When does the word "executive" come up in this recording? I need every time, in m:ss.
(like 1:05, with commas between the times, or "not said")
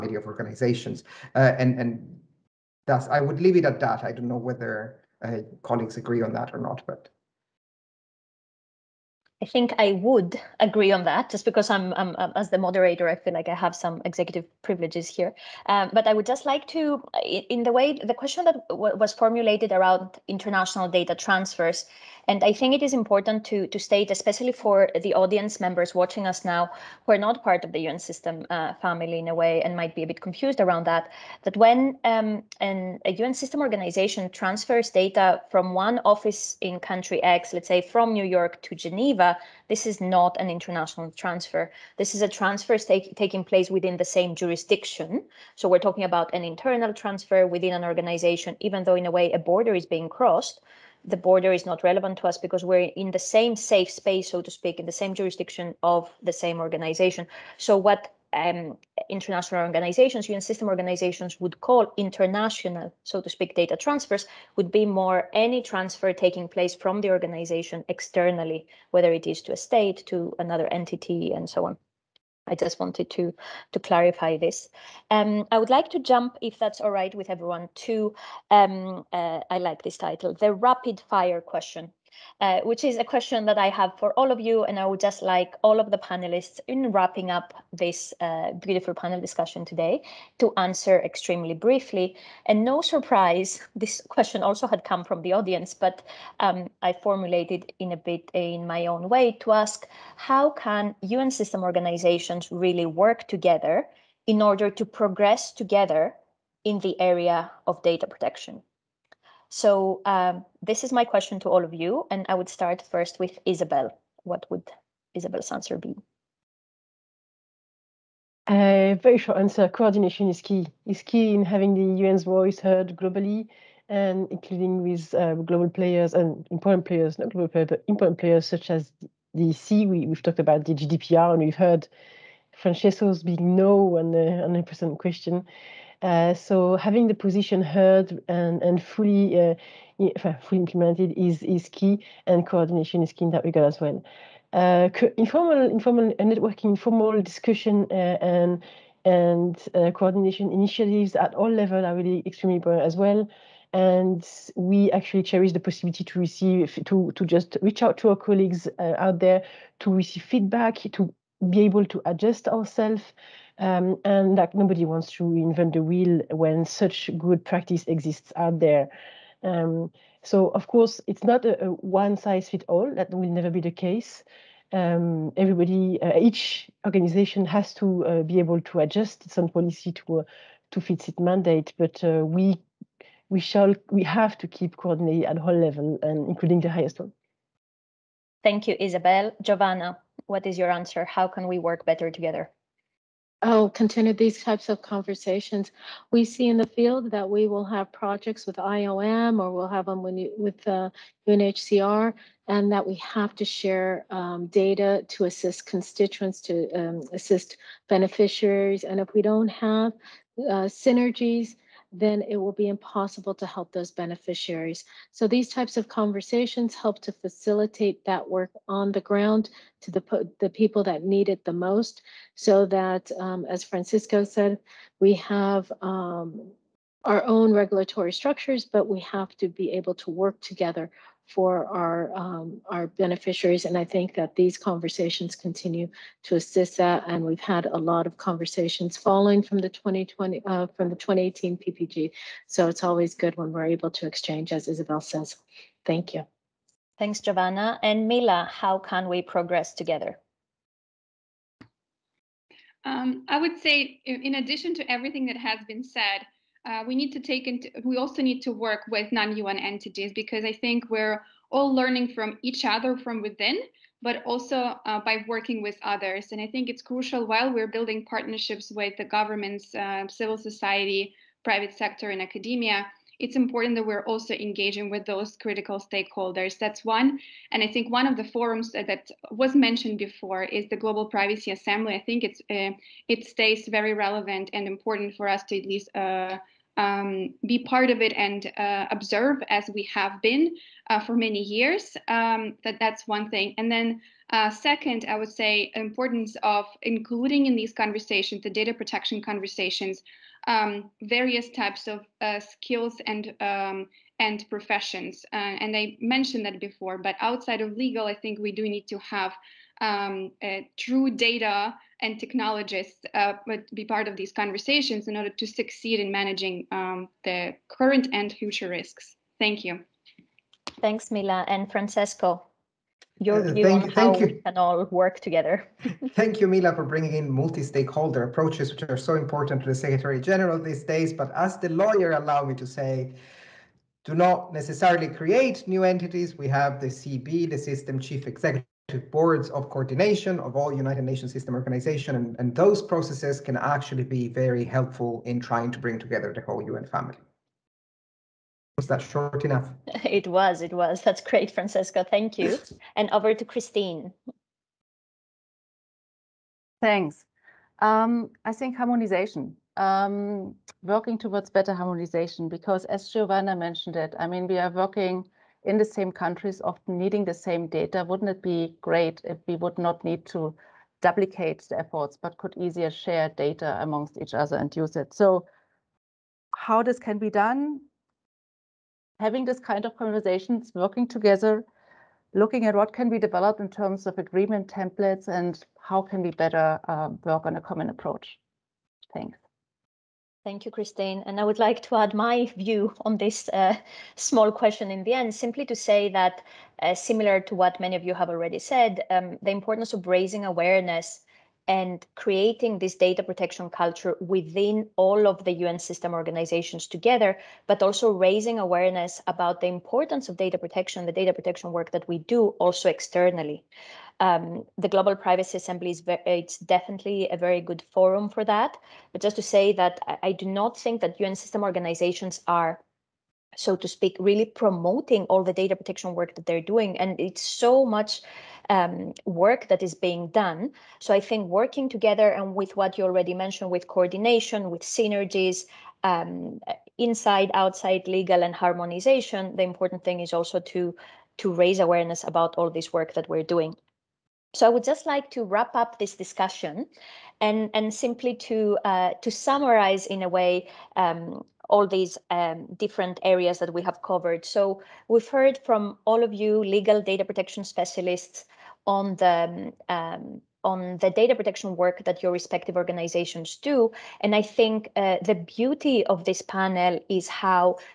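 0:14, 5:38.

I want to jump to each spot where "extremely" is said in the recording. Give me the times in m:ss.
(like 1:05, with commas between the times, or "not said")
1:31, 2:32.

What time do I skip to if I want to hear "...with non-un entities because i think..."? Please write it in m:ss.
4:18.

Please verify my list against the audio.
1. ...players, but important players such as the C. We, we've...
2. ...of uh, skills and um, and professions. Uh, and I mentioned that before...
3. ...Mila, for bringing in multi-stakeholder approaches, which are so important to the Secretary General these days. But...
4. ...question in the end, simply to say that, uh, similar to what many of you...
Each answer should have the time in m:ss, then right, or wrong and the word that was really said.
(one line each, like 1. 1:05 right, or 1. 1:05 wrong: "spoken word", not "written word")
1. 2:07 right
2. 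5:01 right
3. 5:26 right
4. 6:34 right.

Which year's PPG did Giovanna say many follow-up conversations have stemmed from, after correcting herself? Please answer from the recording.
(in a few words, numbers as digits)
2018.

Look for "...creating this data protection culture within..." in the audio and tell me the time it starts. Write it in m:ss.
6:42.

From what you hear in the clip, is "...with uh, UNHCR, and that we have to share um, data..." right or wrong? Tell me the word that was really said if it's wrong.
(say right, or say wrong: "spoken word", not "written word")
right.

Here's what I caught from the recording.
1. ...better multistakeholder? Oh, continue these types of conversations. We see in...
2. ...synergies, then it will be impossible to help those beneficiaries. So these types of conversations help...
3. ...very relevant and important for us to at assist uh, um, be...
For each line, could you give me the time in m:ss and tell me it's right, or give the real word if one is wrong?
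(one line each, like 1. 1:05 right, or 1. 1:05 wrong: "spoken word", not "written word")
1. 3:11 wrong: "together", not "multistakeholder"
2. 3:30 right
3. 4:43 wrong: "least", not "assist".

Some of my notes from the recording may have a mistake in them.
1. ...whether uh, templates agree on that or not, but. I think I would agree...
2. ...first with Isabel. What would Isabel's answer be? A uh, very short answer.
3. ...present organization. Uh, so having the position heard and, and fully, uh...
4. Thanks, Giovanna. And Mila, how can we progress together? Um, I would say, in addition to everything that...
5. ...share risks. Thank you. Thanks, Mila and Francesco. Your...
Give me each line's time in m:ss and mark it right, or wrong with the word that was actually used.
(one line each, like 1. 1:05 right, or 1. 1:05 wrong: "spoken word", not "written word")
1. 0:04 wrong: "colleagues", not "templates"
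2. 1:52 right
3. 2:14 wrong: "question", not "organization"
4. 4:06 right
5. 5:18 wrong: "future", not "share".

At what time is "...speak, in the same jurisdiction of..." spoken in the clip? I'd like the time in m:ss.
0:54.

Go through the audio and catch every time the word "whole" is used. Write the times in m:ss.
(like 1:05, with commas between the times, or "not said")
3:05, 5:46.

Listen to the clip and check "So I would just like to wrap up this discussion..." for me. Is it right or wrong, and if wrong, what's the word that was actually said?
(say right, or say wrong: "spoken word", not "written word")
right.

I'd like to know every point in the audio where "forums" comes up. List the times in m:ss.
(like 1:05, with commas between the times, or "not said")
4:38, 6:57.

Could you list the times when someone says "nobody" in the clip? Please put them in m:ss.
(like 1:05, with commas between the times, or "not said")
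2:44.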